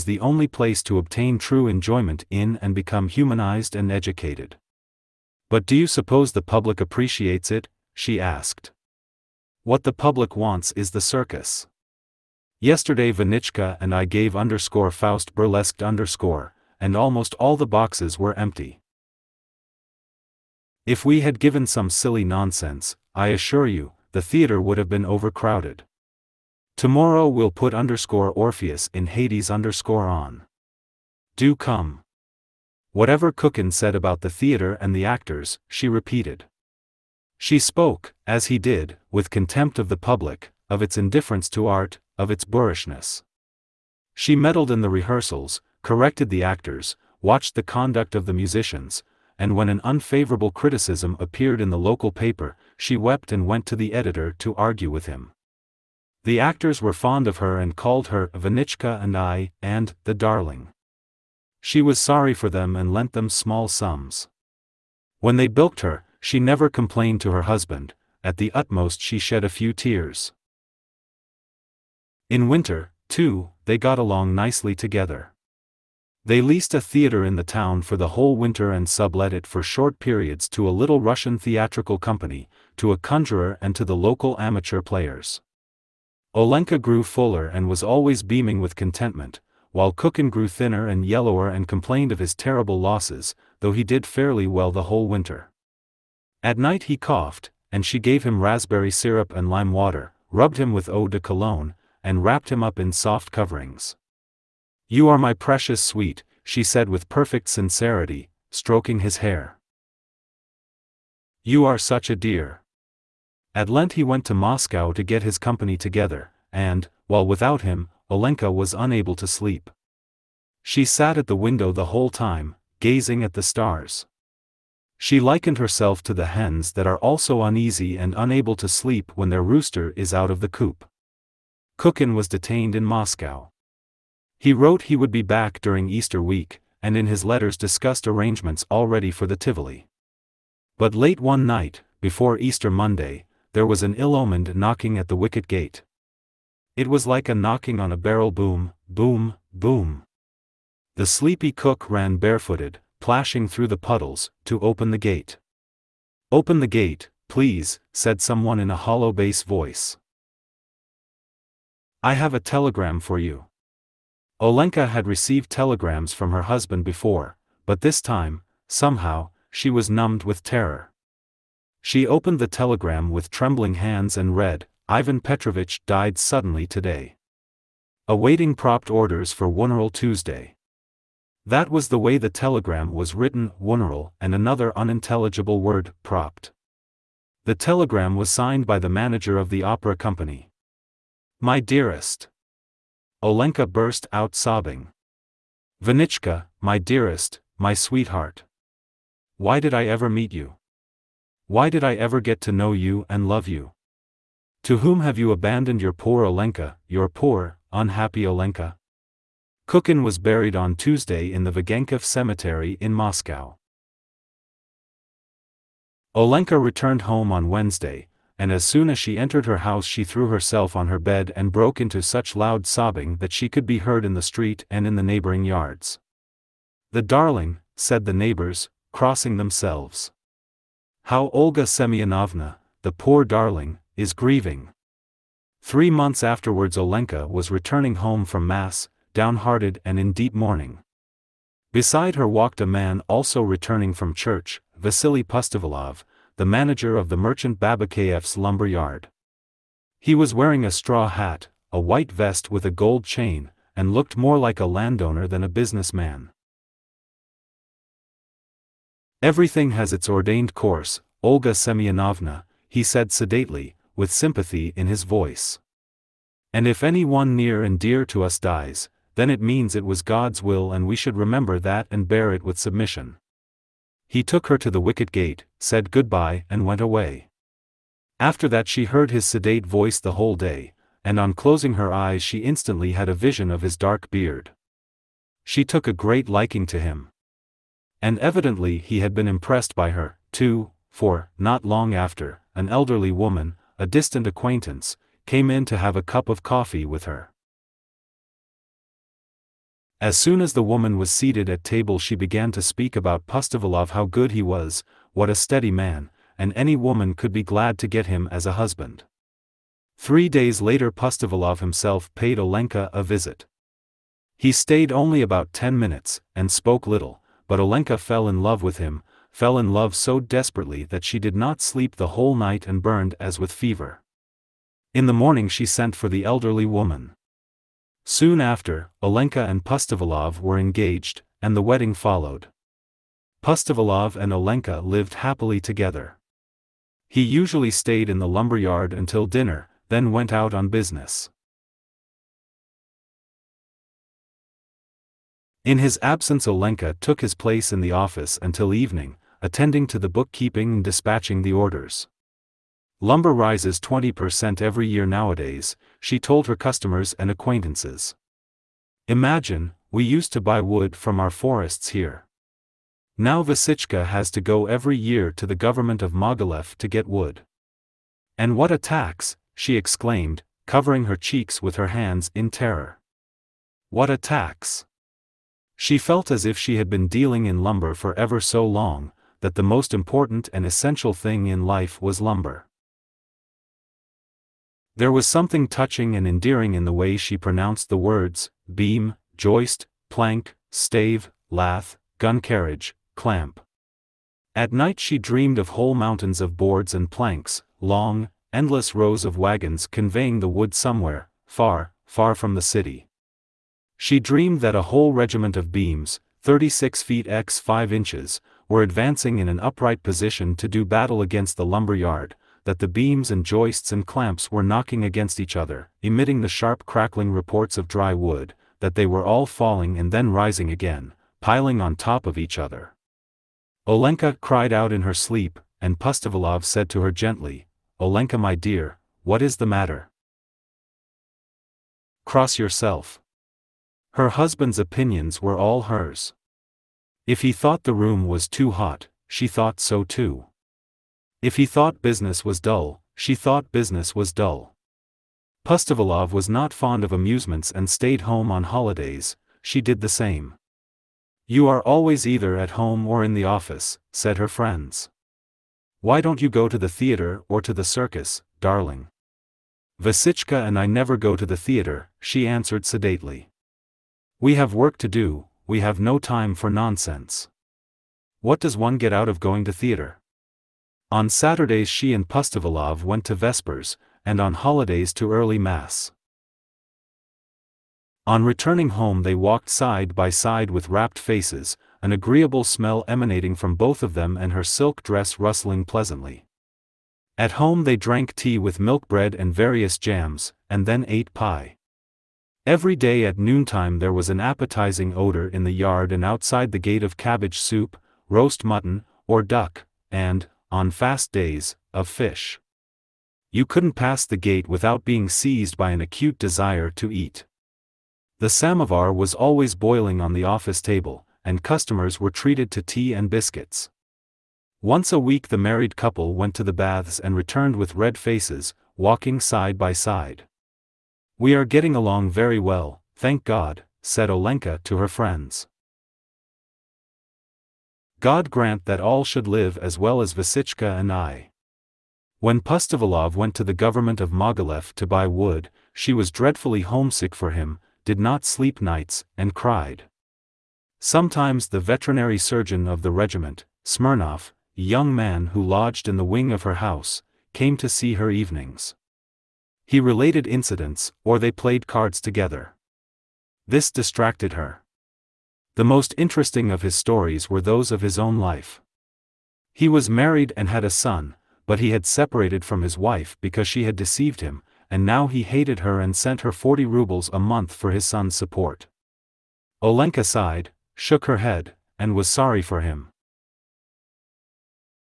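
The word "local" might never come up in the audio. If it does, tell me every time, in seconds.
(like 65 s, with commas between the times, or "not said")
51 s, 83 s.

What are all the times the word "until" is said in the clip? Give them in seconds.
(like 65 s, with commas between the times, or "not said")
338 s, 348 s.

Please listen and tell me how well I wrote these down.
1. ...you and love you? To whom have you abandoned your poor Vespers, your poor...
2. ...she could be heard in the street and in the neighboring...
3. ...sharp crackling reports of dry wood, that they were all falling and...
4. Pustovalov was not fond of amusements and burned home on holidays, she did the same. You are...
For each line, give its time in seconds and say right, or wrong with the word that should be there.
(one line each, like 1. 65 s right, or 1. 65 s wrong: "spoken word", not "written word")
1. 202 s wrong: "Olenka", not "Vespers"
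2. 223 s right
3. 416 s right
4. 445 s wrong: "stayed", not "burned".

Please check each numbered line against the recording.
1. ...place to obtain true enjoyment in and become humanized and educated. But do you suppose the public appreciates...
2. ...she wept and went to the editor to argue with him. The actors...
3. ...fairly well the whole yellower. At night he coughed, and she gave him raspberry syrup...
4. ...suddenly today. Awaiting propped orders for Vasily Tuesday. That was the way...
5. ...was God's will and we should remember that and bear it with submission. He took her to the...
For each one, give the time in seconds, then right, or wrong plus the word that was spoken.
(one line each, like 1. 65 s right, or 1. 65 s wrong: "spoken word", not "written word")
1. 0 s right
2. 52 s right
3. 94 s wrong: "winter", not "yellower"
4. 176 s wrong: "Wuneral", not "Vasily"
5. 269 s right.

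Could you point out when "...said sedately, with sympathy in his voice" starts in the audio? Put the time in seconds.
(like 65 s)
262 s.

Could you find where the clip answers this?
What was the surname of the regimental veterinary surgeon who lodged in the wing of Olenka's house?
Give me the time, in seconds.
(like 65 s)
543 s.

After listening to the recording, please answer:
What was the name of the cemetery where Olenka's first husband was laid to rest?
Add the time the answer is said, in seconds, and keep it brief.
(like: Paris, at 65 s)
Vagankov Cemetery, at 211 s.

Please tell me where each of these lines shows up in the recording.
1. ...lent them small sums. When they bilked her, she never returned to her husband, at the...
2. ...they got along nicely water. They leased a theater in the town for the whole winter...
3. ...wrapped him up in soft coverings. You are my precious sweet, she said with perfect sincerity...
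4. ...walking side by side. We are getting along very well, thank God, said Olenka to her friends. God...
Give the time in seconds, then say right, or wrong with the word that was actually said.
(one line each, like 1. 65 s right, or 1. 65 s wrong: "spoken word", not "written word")
1. 62 s wrong: "complained", not "returned"
2. 73 s wrong: "together", not "water"
3. 102 s right
4. 518 s right.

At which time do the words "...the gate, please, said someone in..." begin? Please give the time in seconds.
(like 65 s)
156 s.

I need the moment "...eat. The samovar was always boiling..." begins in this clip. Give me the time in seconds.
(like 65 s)
507 s.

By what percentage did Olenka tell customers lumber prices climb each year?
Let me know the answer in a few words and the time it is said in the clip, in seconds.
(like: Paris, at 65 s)
20%, at 353 s.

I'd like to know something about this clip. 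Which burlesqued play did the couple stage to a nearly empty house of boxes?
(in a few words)
Faust.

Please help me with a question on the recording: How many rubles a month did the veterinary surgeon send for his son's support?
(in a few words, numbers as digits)
40 rubles.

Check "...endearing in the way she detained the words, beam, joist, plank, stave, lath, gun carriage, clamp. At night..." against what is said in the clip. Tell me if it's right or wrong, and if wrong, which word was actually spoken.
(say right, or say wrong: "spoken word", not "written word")
wrong: "pronounced", not "detained".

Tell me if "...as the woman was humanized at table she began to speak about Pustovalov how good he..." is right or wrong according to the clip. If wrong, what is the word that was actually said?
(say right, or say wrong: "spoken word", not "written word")
wrong: "seated", not "humanized".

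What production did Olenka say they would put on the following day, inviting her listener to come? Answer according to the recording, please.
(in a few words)
Orpheus in Hades.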